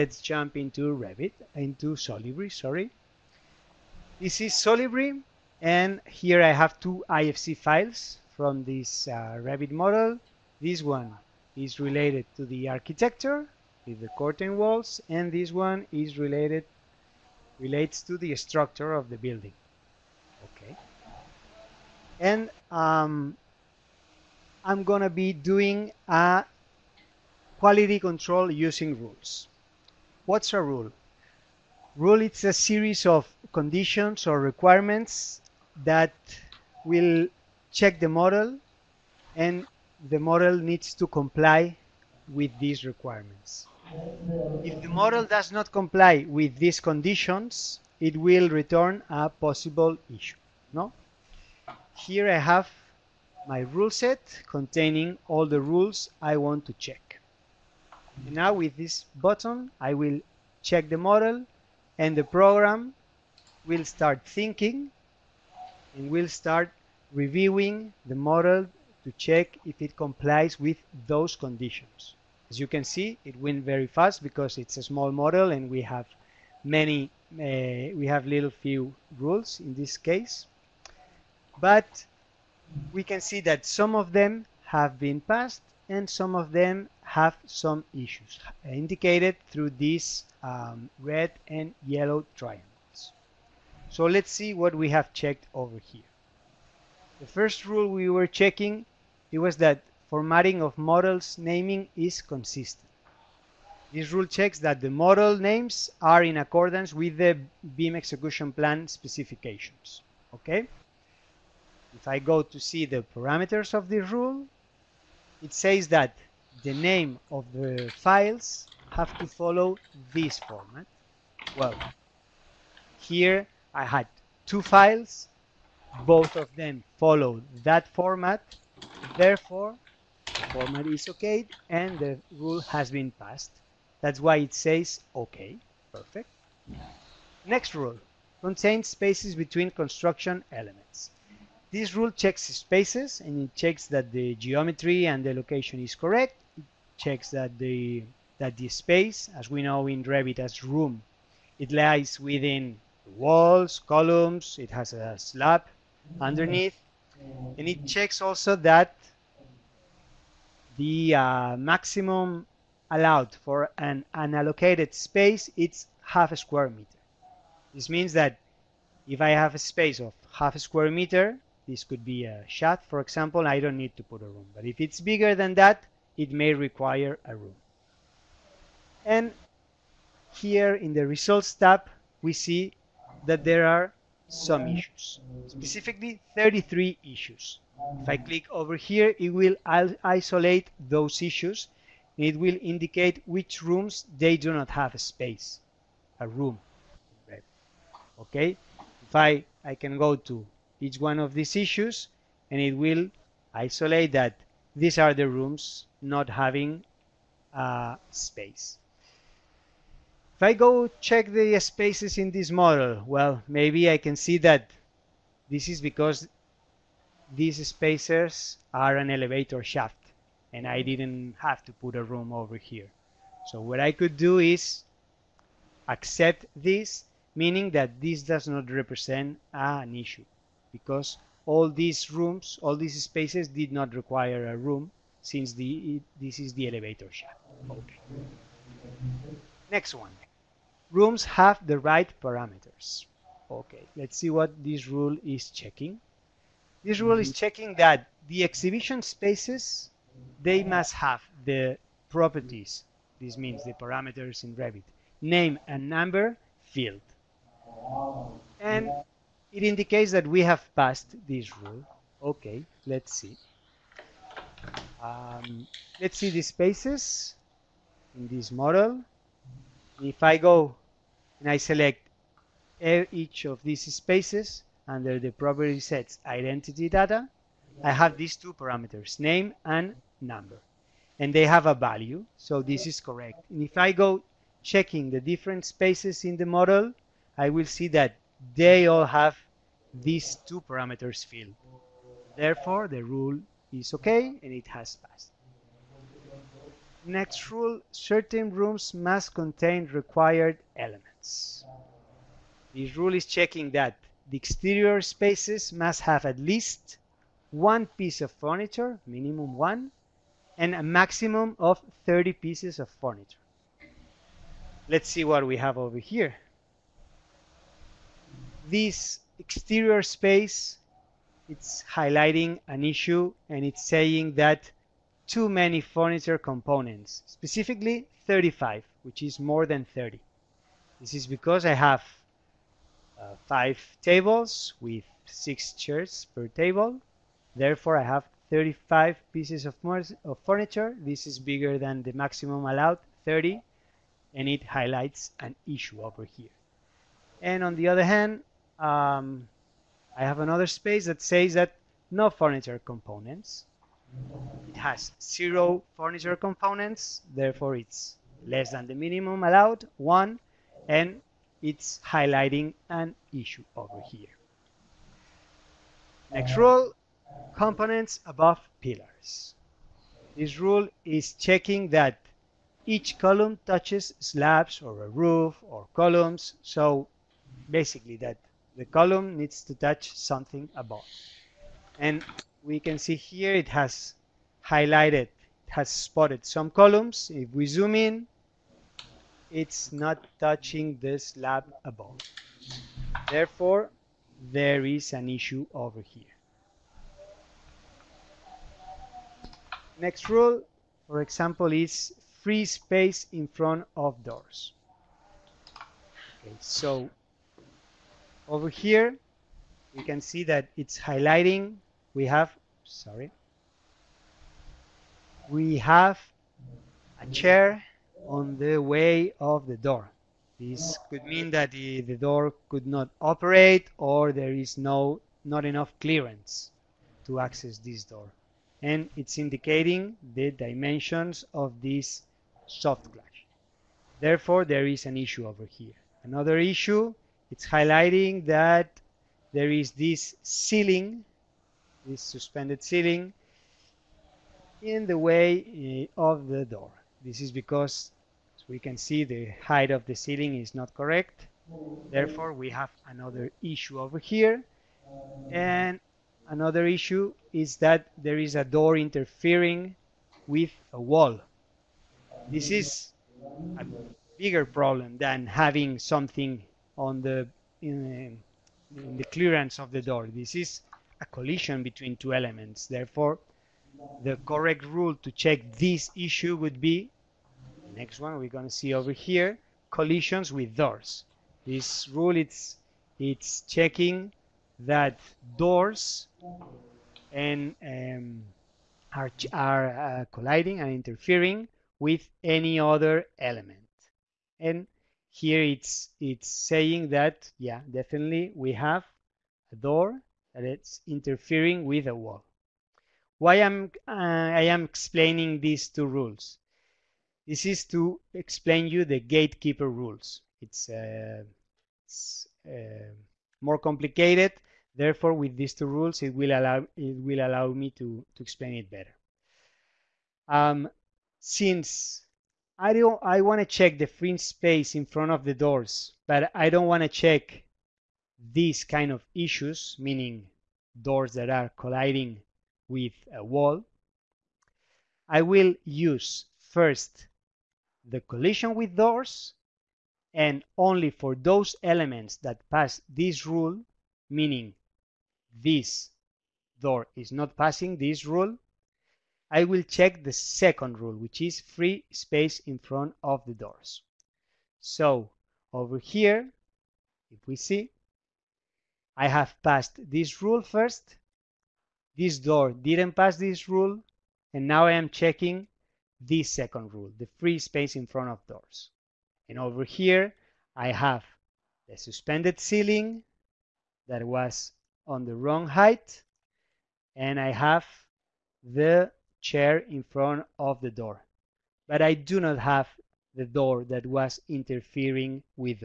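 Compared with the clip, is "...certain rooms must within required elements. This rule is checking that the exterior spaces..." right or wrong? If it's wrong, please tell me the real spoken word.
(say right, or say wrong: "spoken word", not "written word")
wrong: "contain", not "within".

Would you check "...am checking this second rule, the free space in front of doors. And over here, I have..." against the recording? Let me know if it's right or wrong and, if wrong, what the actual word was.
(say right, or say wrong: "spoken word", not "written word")
right.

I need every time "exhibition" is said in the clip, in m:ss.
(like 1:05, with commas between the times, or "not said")
4:08.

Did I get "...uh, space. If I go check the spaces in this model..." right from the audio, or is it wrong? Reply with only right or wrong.
right.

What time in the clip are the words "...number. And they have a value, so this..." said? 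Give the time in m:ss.
4:40.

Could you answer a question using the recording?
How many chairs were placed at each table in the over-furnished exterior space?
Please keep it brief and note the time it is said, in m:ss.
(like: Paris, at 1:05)
6, at 5:35.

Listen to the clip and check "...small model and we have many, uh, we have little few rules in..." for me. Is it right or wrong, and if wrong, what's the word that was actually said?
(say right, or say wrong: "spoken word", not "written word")
right.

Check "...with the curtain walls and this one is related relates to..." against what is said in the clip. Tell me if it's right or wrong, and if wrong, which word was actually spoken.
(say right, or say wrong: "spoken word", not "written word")
right.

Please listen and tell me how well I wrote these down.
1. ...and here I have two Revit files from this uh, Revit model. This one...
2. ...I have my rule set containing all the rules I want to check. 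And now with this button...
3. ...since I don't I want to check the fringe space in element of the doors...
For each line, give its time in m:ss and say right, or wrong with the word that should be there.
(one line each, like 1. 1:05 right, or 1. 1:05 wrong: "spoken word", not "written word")
1. 0:05 wrong: "IFC", not "Revit"
2. 0:52 right
3. 8:41 wrong: "front", not "element".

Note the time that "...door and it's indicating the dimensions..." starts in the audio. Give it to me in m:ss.
7:08.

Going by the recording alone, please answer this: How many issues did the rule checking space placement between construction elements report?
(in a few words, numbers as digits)
33.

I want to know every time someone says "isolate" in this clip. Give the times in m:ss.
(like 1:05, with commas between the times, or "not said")
3:09, 3:23.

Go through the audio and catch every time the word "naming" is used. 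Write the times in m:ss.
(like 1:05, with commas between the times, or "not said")
1:41.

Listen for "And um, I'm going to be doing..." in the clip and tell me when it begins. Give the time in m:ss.
0:22.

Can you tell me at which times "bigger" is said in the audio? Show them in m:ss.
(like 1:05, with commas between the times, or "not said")
2:55, 5:41, 7:44.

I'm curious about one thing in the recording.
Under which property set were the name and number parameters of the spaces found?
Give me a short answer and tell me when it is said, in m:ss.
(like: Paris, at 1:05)
identity data, at 4:36.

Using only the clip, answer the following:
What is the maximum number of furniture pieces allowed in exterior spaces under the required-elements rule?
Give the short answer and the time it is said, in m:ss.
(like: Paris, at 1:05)
30, at 5:10.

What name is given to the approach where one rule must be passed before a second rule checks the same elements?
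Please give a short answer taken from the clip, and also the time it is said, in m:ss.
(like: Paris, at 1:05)
gatekeeper rules, at 8:29.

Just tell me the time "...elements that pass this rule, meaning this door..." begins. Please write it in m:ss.
9:01.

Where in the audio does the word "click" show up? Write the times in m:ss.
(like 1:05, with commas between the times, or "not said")
3:08.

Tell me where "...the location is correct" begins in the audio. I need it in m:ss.
2:25.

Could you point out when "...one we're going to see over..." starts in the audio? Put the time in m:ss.
7:58.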